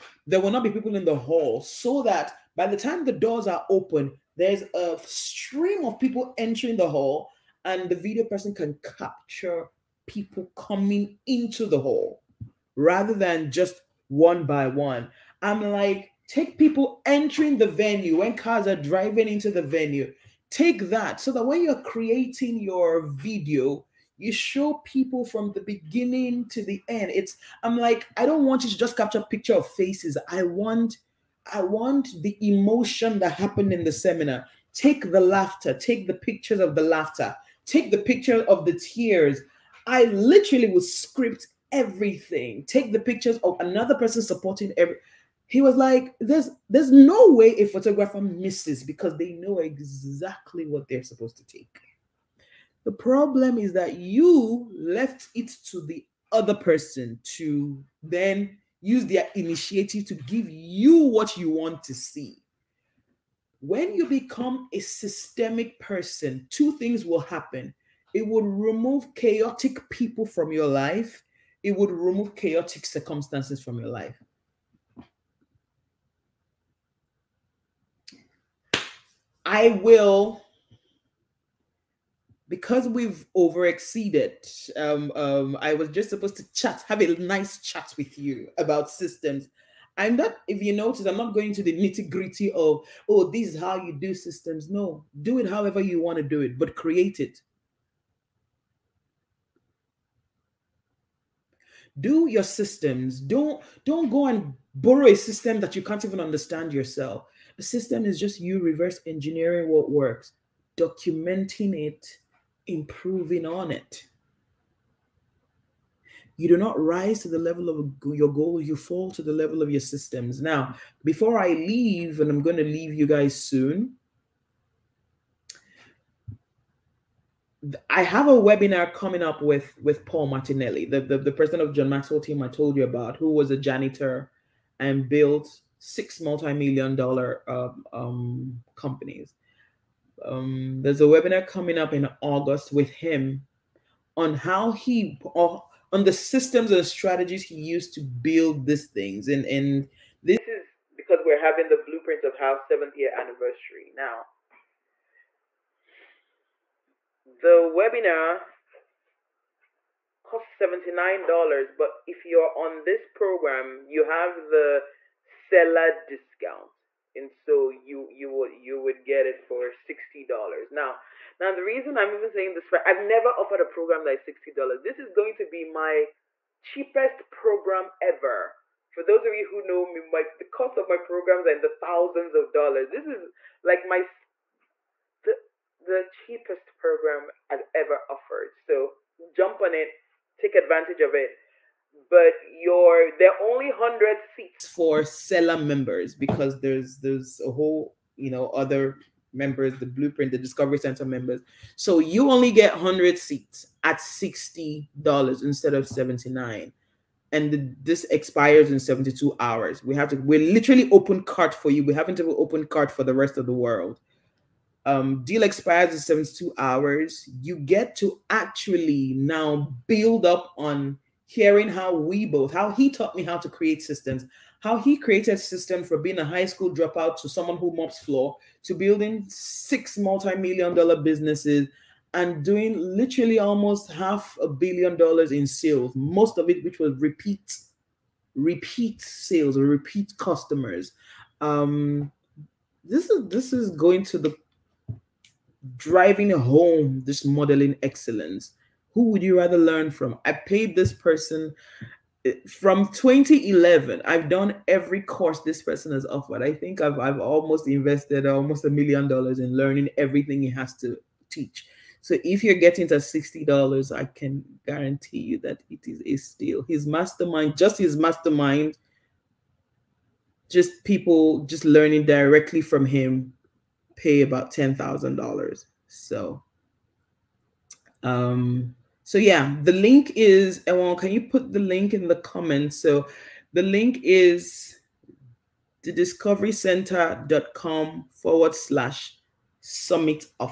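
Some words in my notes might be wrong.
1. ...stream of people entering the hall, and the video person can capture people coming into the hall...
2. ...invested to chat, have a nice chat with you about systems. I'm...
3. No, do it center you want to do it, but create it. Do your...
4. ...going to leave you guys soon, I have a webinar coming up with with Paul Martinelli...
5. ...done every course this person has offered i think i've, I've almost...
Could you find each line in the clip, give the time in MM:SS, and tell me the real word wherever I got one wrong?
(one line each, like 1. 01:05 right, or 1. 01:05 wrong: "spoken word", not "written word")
1. 00:05 right
2. 01:26 wrong: "supposed", not "invested"
3. 01:34 wrong: "however", not "center"
4. 02:02 right
5. 04:14 right.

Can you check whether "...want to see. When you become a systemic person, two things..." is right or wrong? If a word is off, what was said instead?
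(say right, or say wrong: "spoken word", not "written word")
right.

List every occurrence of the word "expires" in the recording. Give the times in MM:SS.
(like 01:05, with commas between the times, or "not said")
03:28, 03:35.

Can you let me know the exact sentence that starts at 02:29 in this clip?
And and this is because we're having the blueprint of how seventh year anniversary now.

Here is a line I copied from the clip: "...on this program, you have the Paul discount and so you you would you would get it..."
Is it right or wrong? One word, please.
wrong.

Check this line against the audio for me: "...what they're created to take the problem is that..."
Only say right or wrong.
wrong.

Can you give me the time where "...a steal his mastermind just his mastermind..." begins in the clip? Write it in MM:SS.
04:26.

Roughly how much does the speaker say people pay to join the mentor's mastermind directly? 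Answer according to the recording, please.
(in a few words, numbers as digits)
$10,000.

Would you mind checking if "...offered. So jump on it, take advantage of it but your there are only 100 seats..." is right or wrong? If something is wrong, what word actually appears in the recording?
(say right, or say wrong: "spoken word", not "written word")
right.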